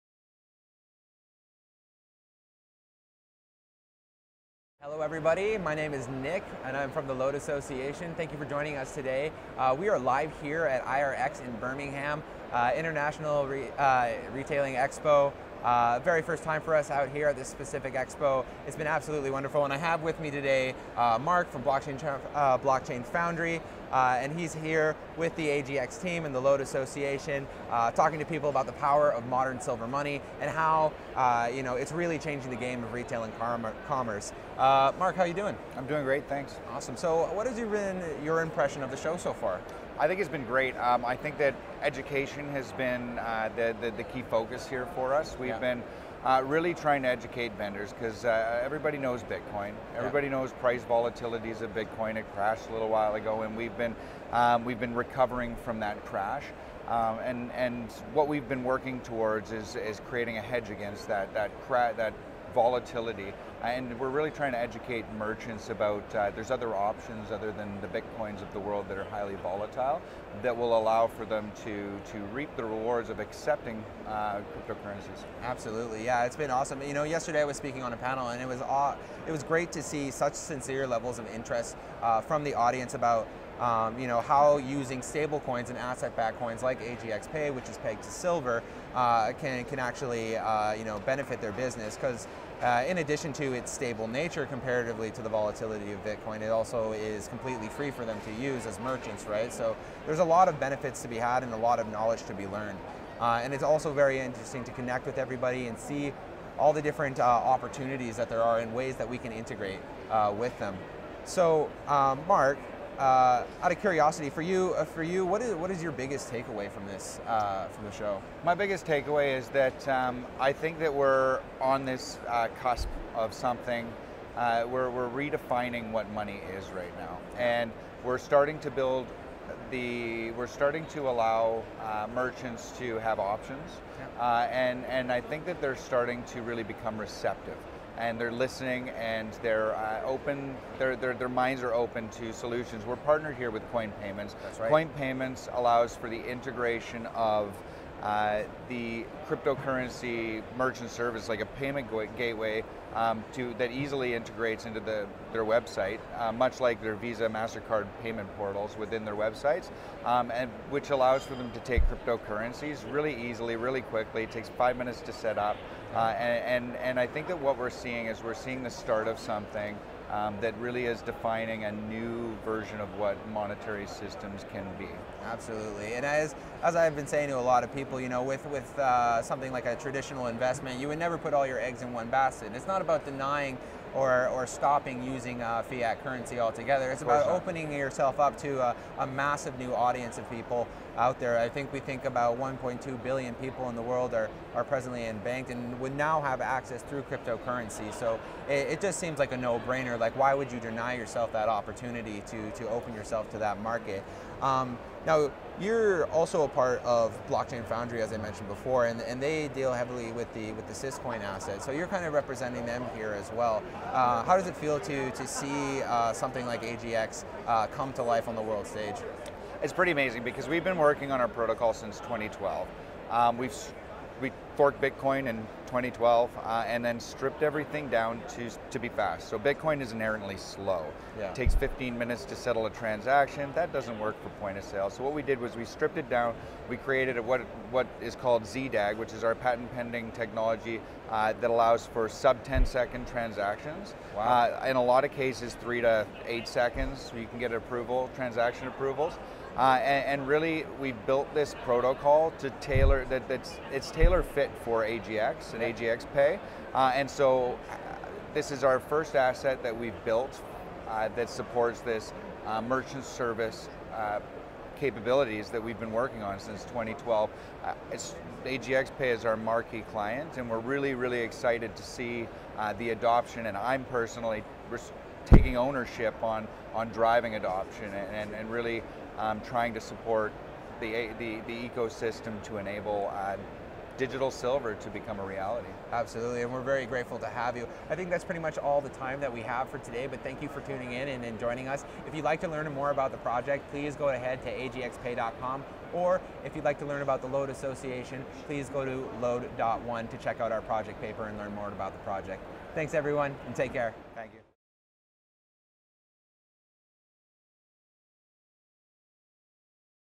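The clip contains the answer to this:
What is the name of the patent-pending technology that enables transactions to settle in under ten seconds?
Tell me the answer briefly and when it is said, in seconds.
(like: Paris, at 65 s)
ZDAG, at 238 s.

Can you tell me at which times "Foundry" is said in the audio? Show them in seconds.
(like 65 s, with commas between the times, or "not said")
23 s, 207 s.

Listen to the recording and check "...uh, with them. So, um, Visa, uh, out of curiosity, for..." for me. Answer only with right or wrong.
wrong.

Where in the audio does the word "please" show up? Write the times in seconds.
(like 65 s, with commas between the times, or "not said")
293 s, 298 s.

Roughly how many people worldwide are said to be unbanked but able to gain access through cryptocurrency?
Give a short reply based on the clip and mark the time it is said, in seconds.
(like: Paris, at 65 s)
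1.2 billion, at 192 s.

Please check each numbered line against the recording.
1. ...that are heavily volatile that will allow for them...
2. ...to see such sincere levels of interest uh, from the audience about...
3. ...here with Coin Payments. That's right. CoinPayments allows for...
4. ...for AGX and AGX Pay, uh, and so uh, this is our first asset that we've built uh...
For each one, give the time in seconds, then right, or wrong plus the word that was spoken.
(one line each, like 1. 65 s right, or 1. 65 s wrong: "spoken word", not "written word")
1. 68 s wrong: "highly", not "heavily"
2. 79 s right
3. 143 s right
4. 254 s right.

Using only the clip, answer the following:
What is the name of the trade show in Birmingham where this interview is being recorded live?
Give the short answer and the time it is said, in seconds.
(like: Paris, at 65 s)
IRX, at 10 s.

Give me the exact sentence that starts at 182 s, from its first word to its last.
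It's not about denying or, or stopping using uh, fiat currency altogether.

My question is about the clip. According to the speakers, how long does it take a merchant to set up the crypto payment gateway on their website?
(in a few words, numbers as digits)
5 minutes.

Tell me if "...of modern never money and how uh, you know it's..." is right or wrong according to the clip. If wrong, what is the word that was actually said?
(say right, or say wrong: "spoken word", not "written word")
wrong: "silver", not "never".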